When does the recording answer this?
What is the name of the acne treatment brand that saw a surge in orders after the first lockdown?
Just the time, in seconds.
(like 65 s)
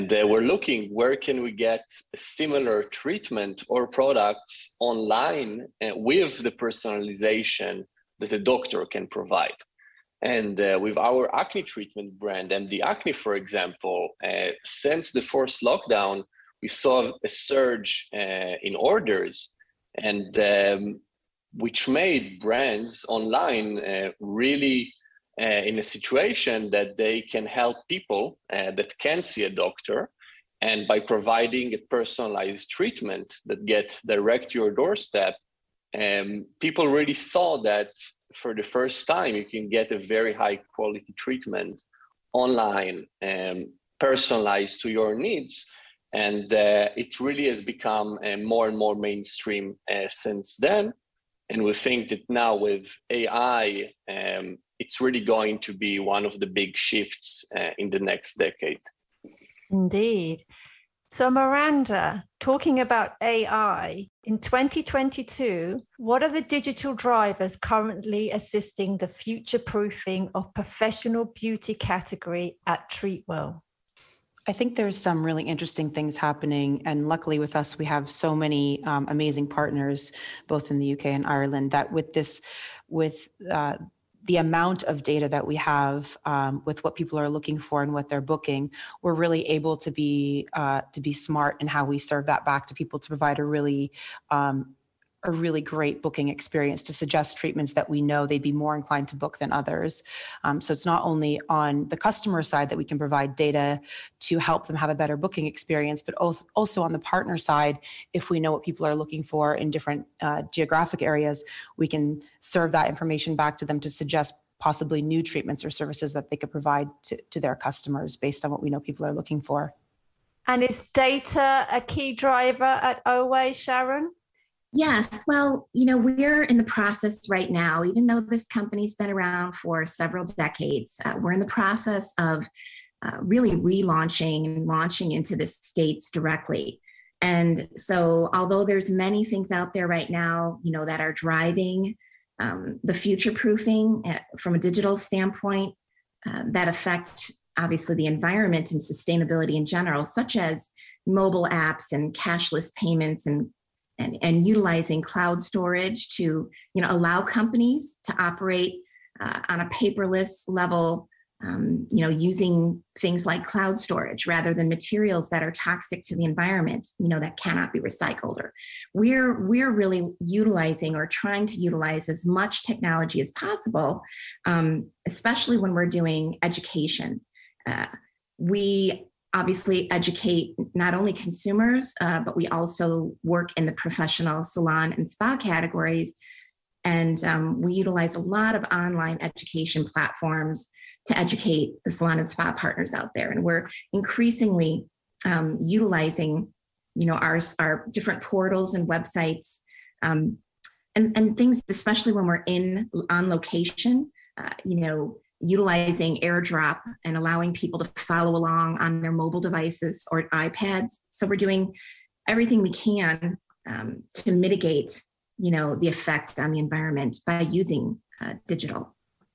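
12 s.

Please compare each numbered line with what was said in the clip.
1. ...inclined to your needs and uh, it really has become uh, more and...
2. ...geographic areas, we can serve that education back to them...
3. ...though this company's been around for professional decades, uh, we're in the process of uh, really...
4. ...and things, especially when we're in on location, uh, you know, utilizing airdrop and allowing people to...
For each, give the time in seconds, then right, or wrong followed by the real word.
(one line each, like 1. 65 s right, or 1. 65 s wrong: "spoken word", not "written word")
1. 43 s wrong: "personalized", not "inclined"
2. 110 s wrong: "information", not "education"
3. 128 s wrong: "several", not "professional"
4. 201 s right.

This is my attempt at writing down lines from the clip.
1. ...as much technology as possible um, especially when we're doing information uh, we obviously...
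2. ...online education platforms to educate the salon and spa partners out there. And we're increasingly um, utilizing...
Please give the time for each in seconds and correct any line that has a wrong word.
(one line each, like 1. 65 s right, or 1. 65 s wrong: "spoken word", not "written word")
1. 172 s wrong: "education", not "information"
2. 188 s right.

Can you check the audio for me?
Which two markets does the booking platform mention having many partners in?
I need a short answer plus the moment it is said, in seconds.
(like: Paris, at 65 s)
UK and Ireland, at 80 s.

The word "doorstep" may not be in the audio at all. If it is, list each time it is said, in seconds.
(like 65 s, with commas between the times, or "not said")
34 s.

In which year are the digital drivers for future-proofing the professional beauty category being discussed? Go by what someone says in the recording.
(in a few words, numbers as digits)
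2022.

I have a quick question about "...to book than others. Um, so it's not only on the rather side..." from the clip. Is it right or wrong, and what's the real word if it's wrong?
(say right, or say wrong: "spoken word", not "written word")
wrong: "customer", not "rather".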